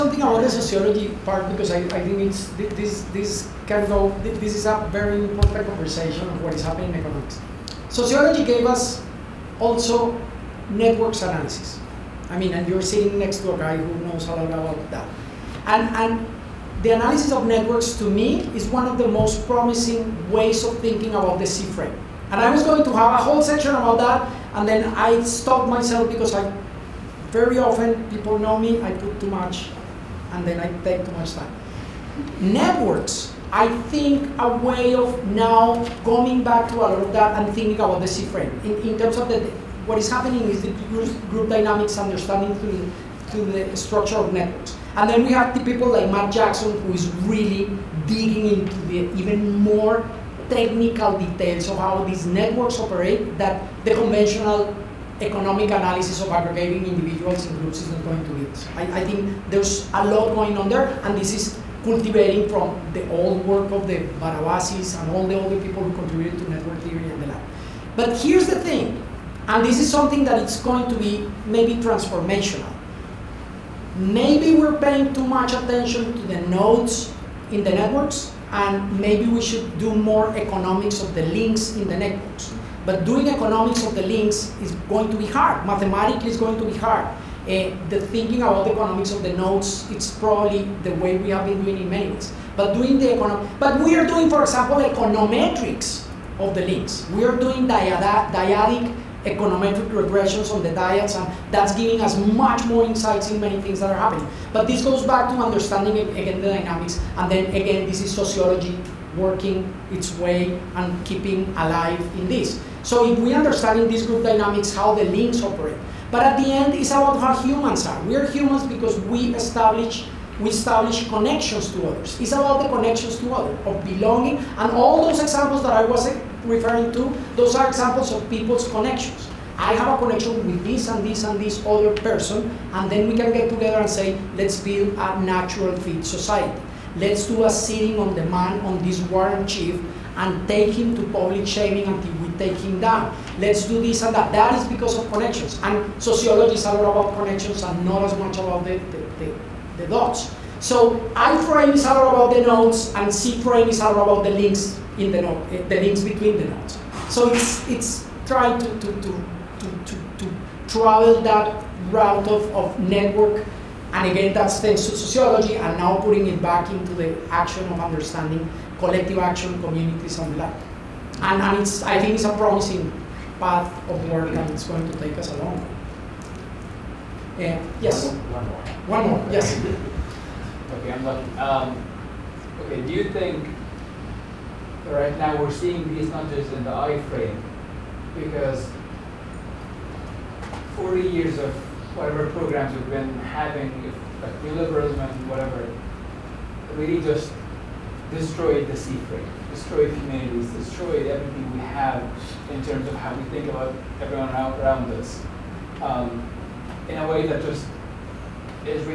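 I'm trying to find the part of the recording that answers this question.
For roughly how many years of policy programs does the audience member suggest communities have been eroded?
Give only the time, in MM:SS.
03:10.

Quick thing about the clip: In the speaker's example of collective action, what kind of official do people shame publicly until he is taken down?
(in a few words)
warrant chief.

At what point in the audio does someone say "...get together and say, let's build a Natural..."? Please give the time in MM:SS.
02:13.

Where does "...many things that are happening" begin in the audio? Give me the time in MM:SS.
01:43.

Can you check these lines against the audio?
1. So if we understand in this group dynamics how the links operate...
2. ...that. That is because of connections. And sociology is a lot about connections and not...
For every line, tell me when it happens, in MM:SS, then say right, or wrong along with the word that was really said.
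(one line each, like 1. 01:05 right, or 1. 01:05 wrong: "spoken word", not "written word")
1. 01:52 right
2. 02:24 right.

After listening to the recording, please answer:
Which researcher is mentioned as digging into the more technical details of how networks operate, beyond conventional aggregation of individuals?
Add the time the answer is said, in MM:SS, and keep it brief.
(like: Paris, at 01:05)
Matt Jackson, at 00:46.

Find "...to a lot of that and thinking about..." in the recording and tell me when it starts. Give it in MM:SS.
00:36.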